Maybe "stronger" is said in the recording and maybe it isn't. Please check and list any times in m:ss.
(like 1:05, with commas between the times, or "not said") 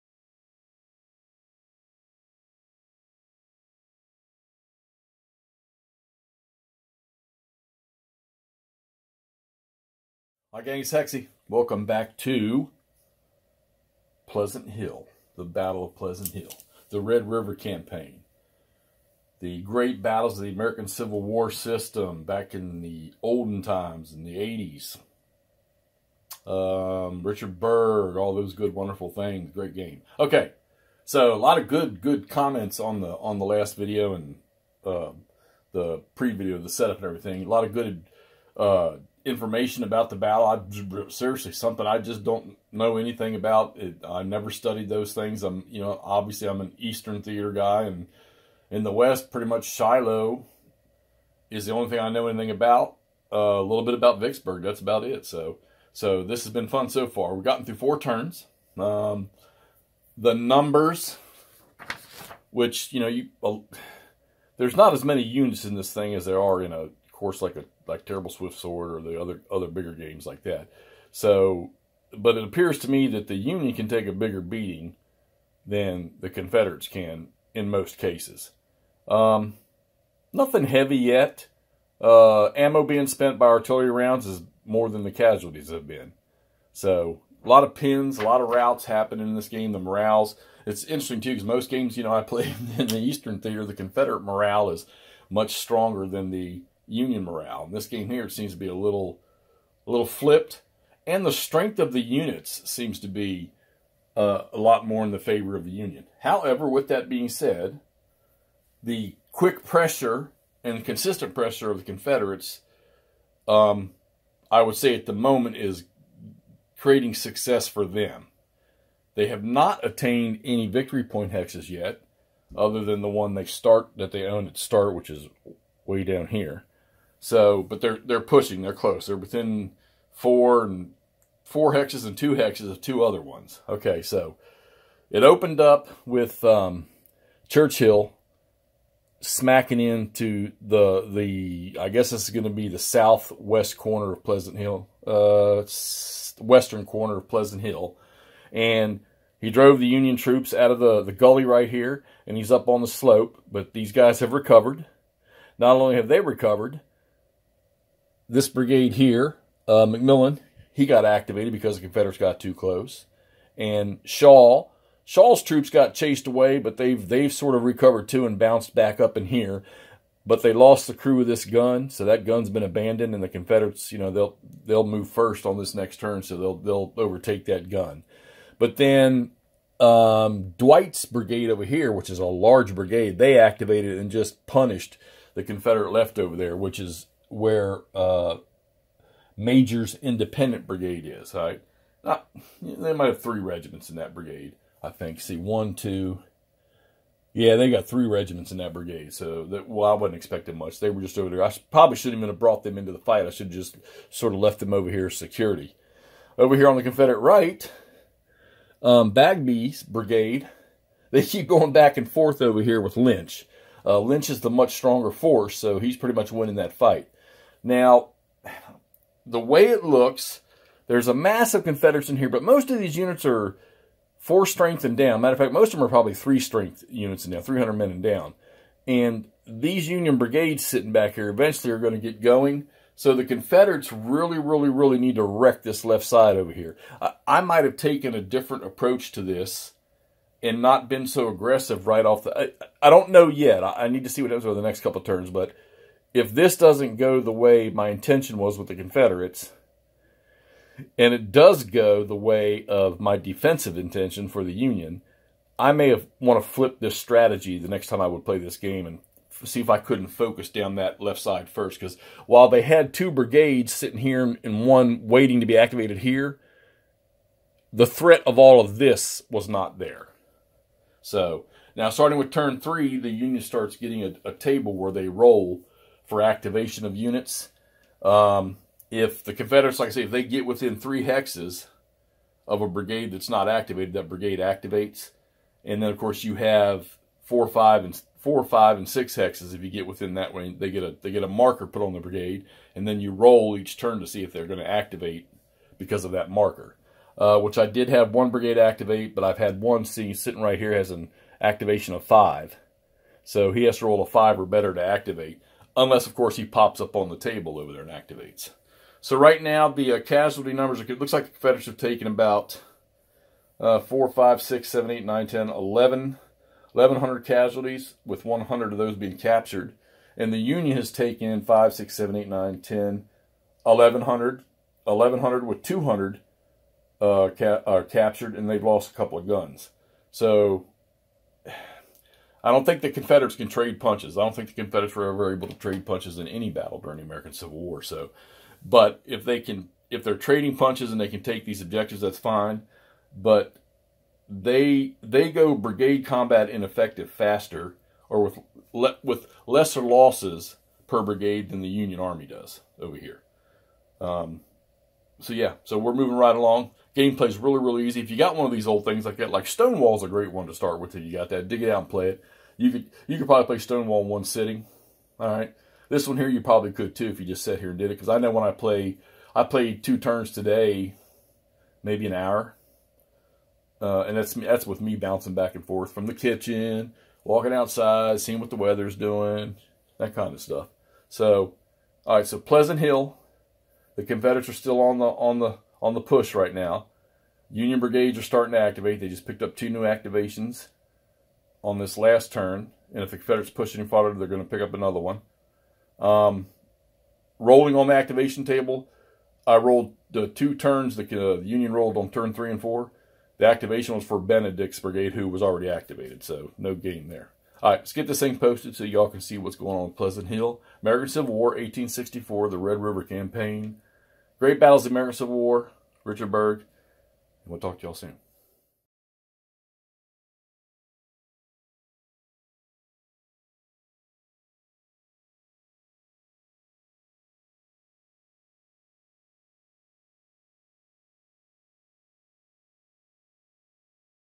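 1:35, 3:34.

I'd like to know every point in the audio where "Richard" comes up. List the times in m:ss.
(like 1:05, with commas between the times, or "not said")
0:27, 6:56.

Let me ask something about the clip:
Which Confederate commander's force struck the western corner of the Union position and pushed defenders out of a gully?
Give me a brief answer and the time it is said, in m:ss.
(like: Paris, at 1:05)
Churchill, at 2:17.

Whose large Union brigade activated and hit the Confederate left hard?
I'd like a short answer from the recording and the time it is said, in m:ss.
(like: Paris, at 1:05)
Dwight's brigade, at 3:00.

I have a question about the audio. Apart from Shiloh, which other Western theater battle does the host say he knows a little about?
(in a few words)
Vicksburg.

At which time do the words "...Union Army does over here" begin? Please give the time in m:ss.
5:51.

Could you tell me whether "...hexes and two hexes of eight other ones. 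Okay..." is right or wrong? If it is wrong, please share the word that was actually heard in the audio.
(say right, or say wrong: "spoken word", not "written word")
wrong: "two", not "eight".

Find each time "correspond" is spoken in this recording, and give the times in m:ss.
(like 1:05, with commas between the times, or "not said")
not said.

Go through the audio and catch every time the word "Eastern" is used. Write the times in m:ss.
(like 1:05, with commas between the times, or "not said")
0:46, 1:32.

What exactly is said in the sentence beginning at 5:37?
So, but if they can, if they're trading punches and they can take these objectives, that's fine.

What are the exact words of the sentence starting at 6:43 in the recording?
The activation was for Benedict's brigade, who was already activated, so no game there.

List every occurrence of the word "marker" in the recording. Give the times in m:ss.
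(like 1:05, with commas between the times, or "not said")
4:51, 4:56.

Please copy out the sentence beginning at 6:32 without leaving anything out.
And if the Confederates push any farther, they're going to pick up another one.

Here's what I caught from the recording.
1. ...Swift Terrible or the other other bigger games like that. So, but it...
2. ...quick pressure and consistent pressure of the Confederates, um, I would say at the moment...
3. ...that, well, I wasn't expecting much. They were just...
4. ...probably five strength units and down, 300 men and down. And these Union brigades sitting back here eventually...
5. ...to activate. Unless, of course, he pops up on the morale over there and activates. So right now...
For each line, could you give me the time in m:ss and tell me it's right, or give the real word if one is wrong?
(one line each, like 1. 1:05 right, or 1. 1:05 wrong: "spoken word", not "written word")
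1. 1:08 wrong: "Sword", not "Terrible"
2. 1:49 right
3. 3:19 right
4. 3:45 wrong: "three", not "five"
5. 5:04 wrong: "table", not "morale".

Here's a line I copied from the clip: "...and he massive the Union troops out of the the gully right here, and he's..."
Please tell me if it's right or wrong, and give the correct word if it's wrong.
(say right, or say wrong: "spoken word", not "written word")
wrong: "drove", not "massive".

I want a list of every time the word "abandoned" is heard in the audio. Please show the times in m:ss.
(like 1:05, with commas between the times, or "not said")
2:52.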